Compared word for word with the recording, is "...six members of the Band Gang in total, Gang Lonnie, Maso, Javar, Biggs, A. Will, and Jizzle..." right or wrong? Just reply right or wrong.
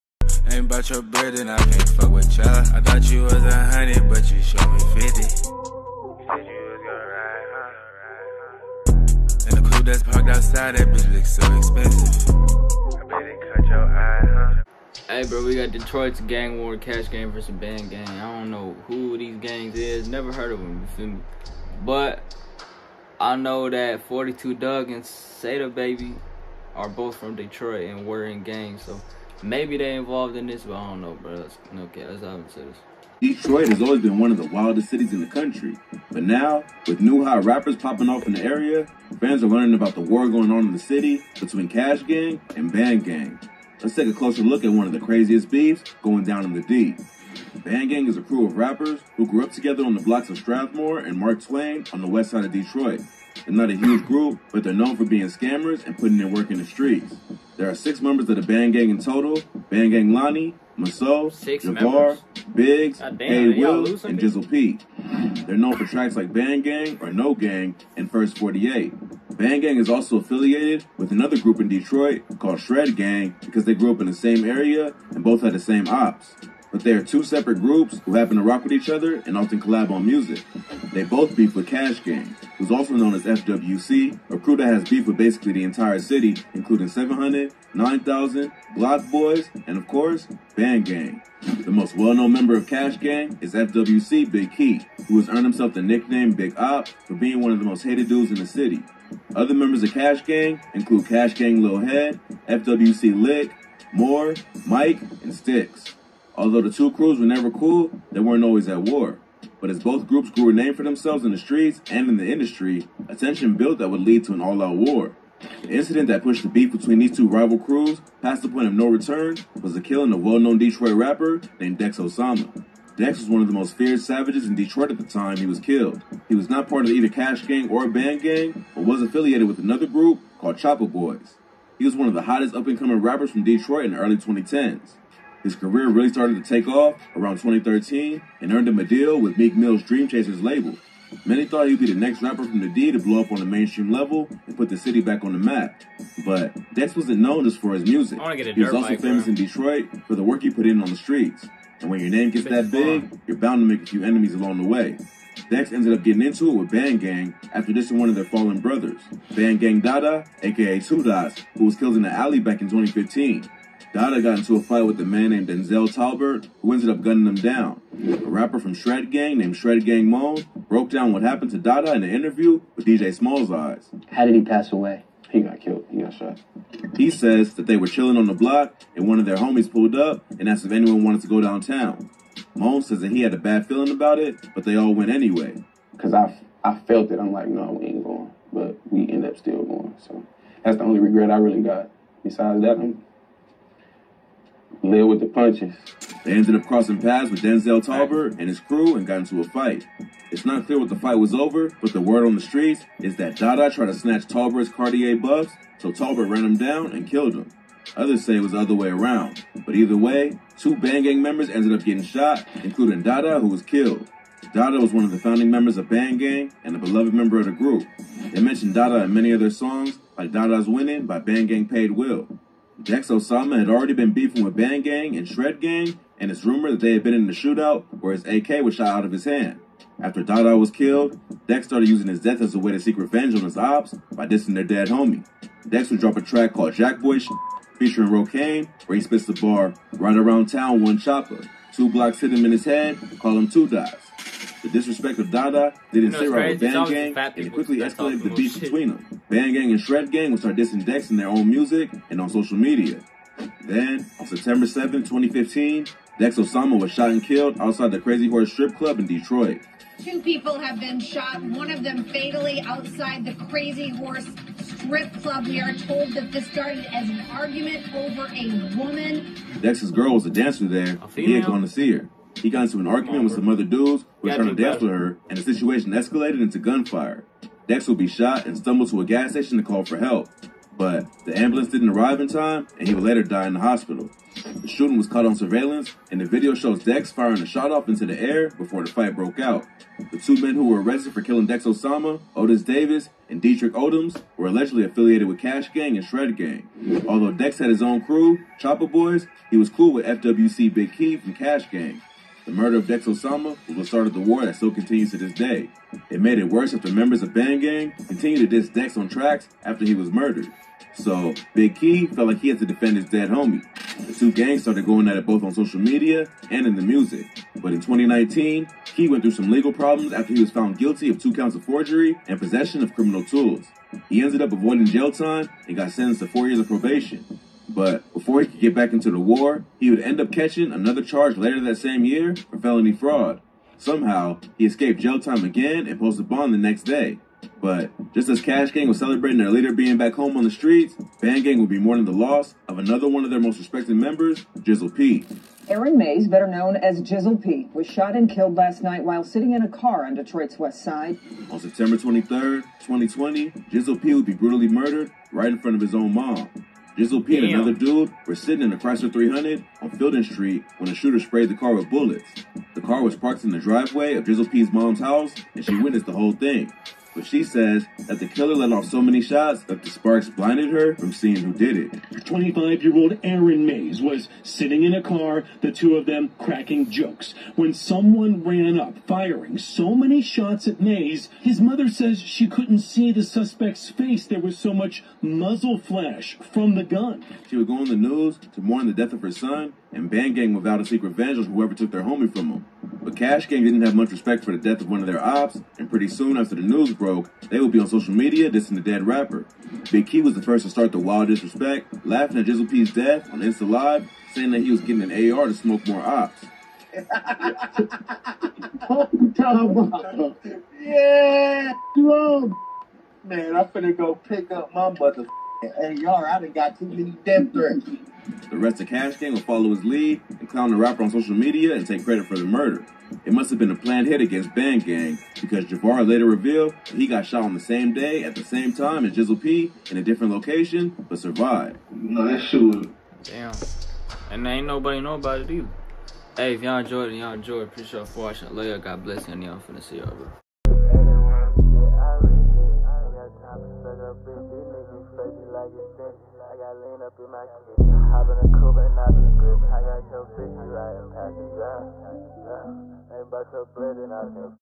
right.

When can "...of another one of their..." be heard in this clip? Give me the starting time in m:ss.
5:42.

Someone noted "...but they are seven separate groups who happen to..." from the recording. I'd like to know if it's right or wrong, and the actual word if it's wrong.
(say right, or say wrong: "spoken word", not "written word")
wrong: "two", not "seven".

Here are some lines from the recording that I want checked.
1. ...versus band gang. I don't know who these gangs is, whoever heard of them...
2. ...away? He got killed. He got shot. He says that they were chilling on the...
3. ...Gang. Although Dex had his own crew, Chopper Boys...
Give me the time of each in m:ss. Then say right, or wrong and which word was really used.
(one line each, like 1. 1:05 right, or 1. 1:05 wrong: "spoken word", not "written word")
1. 0:17 wrong: "never", not "whoever"
2. 2:54 right
3. 4:56 right.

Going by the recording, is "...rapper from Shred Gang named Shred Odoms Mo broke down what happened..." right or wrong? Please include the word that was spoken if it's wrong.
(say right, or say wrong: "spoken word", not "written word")
wrong: "Gang", not "Odoms".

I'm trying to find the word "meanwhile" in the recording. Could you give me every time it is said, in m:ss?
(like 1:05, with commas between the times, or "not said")
not said.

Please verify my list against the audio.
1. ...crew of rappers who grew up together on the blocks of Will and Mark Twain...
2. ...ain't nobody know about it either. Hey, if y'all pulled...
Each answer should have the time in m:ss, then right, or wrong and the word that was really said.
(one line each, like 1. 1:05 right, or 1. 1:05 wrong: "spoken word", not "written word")
1. 0:48 wrong: "Strathmore", not "Will"
2. 7:14 wrong: "enjoyed", not "pulled".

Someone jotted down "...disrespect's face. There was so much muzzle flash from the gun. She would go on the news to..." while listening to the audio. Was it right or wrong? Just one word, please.
wrong.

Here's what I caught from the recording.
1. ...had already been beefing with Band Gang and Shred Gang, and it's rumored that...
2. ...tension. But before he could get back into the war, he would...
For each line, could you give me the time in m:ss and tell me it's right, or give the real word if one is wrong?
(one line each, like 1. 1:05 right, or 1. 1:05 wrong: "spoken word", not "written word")
1. 3:43 right
2. 5:26 wrong: "probation", not "tension".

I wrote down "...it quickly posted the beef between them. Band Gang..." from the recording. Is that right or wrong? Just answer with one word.
wrong.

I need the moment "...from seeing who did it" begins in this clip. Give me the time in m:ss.
6:10.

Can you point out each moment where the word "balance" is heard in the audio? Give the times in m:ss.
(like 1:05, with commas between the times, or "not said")
not said.